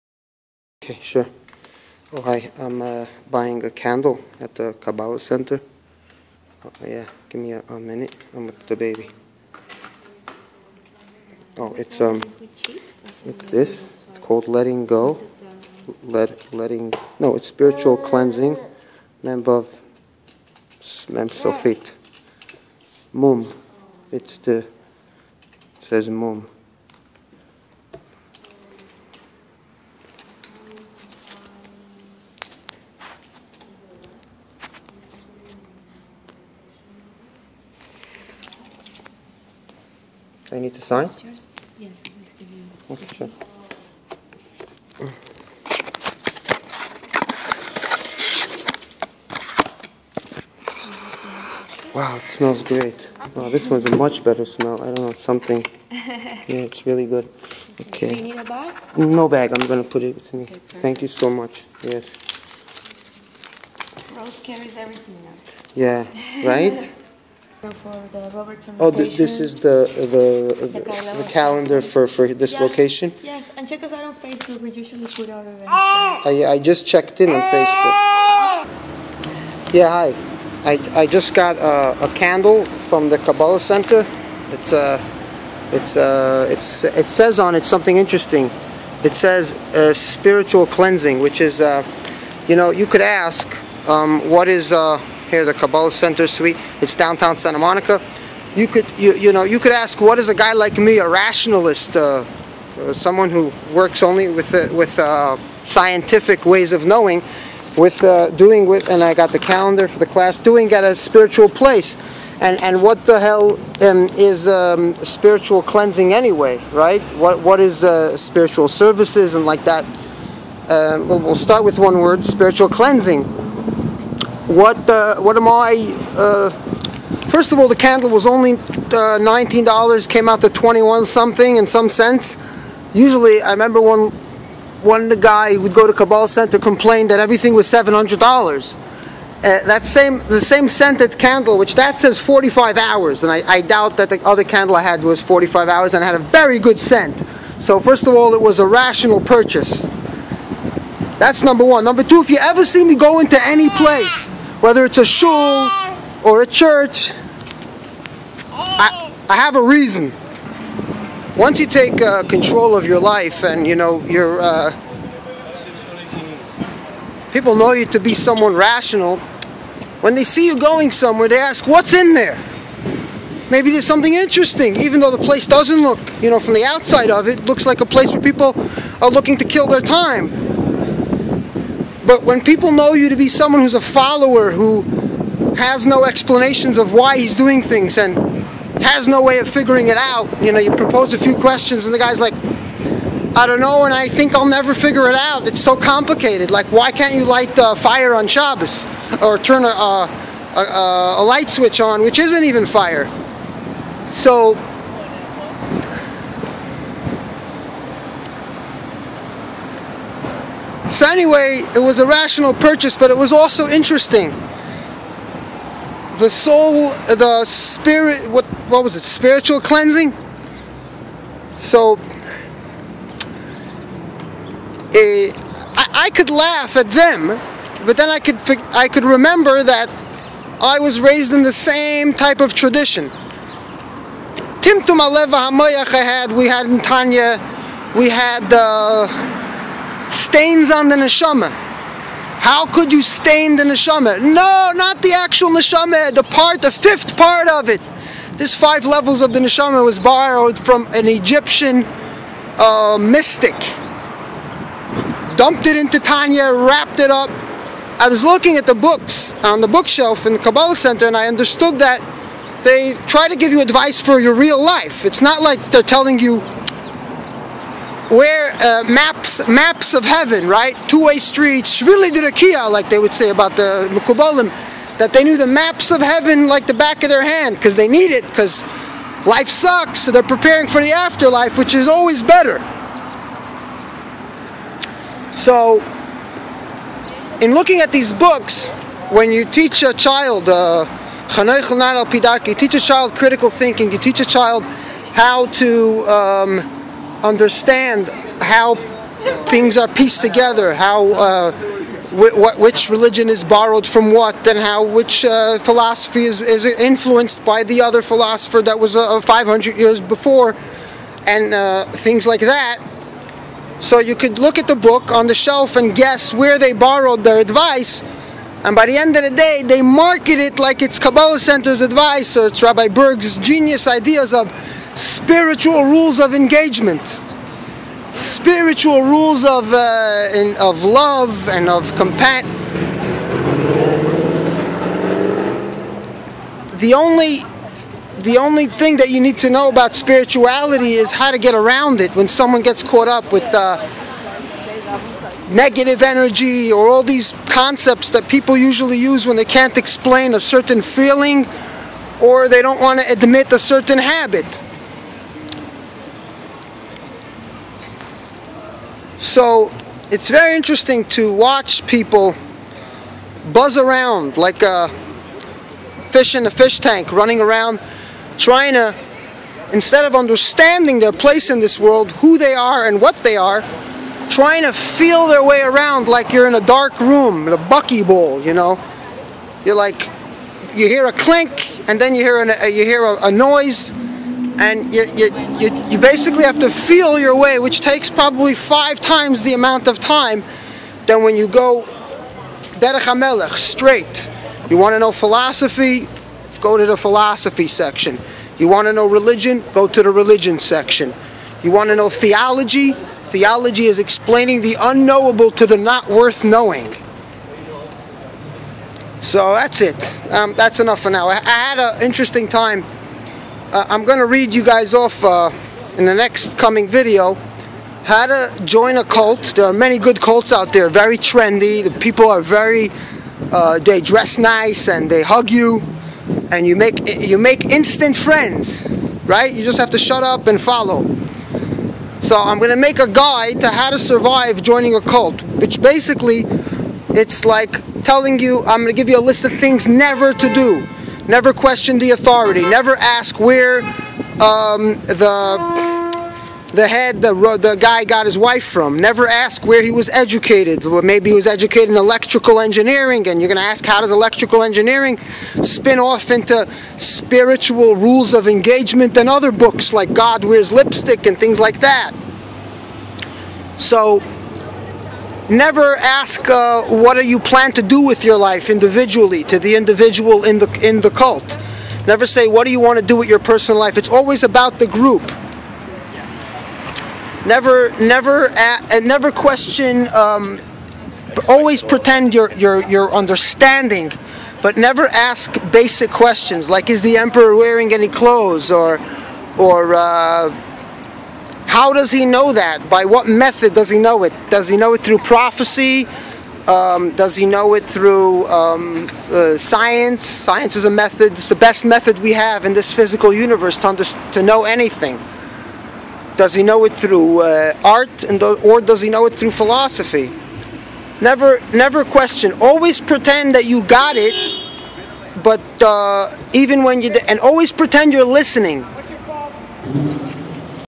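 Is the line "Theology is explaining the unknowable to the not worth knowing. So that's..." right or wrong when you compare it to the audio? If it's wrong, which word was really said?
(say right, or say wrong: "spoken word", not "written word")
right.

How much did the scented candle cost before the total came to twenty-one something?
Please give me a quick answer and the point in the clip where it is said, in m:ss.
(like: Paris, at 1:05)
$19, at 2:09.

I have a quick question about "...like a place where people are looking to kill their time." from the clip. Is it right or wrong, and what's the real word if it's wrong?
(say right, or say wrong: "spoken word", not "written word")
right.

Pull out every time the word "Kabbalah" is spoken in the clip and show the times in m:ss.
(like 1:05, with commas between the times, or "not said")
0:04, 1:23, 1:35, 2:15, 4:20, 5:20.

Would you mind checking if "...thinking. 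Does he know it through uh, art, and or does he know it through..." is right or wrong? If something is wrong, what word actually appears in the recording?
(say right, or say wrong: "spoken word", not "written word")
wrong: "anything", not "thinking".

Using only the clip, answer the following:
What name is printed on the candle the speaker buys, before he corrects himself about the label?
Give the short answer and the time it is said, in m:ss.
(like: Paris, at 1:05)
Letting go, at 0:14.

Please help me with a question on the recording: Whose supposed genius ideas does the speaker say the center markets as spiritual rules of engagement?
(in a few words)
Rabbi Berg.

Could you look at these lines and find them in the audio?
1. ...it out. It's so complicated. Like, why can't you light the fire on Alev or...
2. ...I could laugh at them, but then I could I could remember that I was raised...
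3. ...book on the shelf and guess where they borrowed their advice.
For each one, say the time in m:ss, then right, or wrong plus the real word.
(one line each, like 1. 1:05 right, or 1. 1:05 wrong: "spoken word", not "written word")
1. 3:15 wrong: "Shabbos", not "Alev"
2. 3:46 right
3. 5:14 right.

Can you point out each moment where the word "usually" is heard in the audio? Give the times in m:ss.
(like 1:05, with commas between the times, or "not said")
1:14, 2:12, 5:48.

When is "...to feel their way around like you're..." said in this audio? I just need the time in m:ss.
6:14.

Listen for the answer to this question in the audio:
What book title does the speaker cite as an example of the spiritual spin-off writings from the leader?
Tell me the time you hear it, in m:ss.
7:40.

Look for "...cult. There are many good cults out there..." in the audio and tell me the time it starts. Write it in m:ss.
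6:59.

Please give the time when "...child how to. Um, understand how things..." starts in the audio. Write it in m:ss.
4:54.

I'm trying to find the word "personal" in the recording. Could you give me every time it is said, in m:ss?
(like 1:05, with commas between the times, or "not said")
7:53.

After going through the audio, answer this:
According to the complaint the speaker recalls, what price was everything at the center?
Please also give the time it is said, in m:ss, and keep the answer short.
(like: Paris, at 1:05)
$700, at 2:17.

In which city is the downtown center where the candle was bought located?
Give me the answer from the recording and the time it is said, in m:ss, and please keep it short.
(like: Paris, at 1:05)
Santa Monica, at 1:37.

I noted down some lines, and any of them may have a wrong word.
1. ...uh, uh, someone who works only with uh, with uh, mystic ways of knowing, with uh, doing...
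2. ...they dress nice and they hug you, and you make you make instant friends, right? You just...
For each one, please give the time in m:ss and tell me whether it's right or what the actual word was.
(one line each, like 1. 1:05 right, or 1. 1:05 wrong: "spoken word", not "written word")
1. 1:41 wrong: "scientific", not "mystic"
2. 7:03 right.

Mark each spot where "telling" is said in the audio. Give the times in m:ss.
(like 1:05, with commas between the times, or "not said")
4:25, 7:18.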